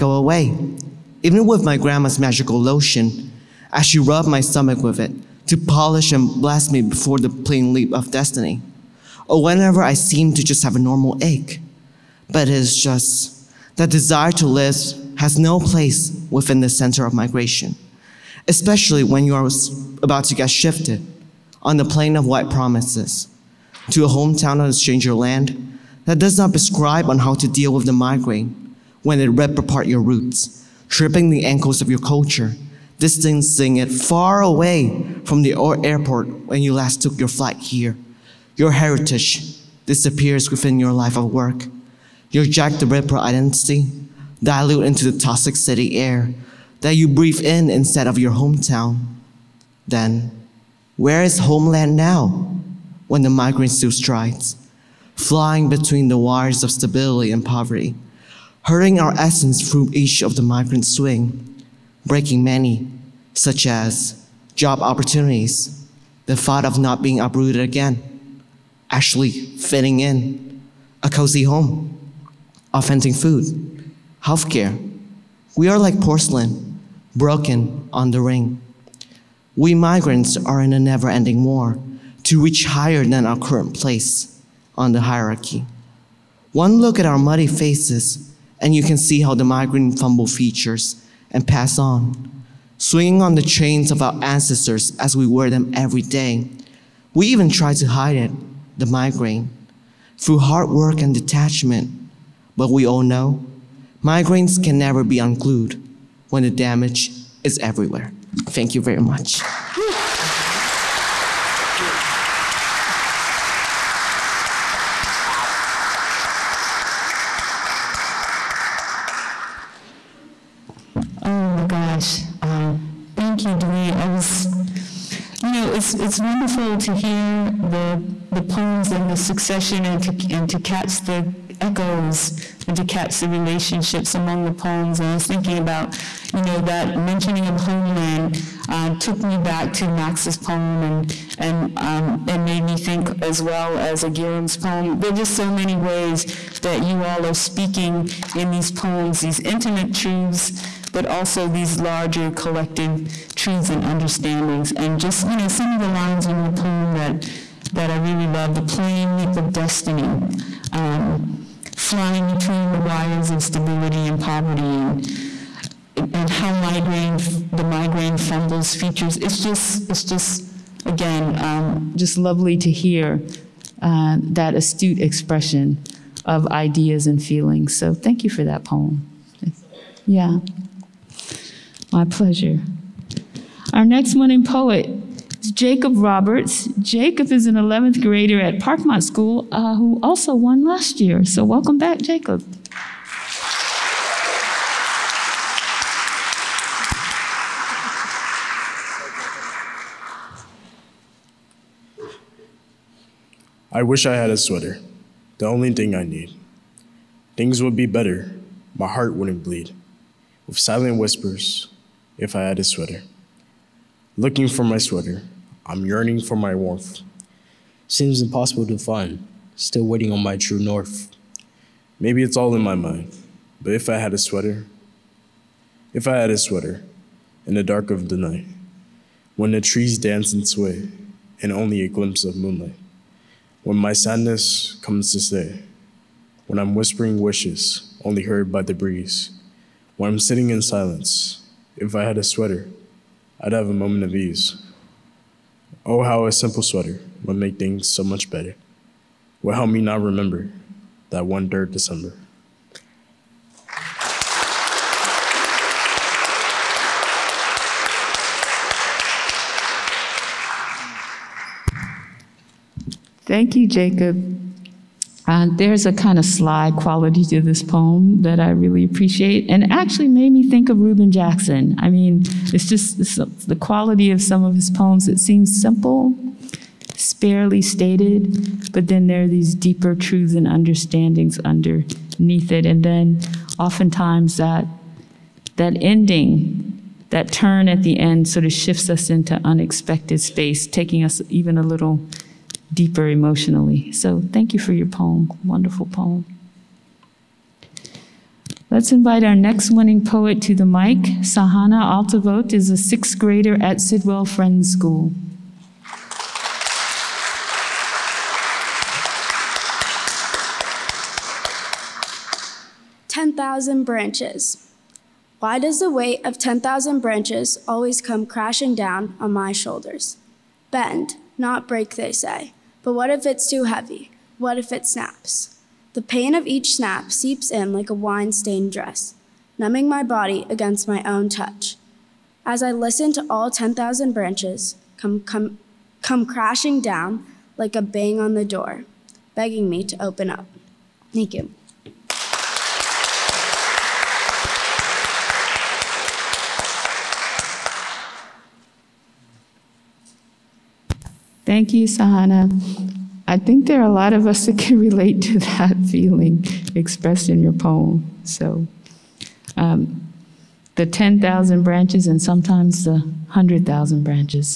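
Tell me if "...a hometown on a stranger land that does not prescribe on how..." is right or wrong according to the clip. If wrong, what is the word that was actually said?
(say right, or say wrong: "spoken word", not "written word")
right.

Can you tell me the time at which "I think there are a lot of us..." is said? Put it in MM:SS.
05:53.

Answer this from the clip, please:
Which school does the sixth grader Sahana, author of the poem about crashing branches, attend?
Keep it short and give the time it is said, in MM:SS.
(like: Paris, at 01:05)
Sidwell Friends School, at 05:03.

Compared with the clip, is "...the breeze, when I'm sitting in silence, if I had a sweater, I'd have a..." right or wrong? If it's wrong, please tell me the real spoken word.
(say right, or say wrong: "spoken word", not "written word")
right.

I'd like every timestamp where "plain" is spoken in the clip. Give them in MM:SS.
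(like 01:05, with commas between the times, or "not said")
00:07, 02:38.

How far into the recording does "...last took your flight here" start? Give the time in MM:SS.
00:36.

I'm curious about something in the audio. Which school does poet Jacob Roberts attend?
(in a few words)
Parkmont School.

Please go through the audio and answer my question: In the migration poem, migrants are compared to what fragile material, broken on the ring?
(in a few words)
porcelain.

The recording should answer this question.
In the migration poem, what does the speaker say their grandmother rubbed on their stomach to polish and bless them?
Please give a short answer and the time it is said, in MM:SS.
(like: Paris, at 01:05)
magical lotion, at 00:02.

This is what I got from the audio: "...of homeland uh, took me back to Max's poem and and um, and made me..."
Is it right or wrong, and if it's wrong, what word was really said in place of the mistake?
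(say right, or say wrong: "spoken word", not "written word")
right.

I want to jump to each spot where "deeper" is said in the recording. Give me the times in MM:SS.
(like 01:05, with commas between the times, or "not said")
04:39, 04:52.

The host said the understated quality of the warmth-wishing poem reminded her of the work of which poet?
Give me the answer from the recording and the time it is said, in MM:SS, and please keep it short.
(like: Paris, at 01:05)
Reuben Jackson, at 04:30.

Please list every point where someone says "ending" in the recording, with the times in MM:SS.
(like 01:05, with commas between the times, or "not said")
01:21, 04:45.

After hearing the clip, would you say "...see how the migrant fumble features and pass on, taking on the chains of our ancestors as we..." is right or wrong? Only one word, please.
wrong.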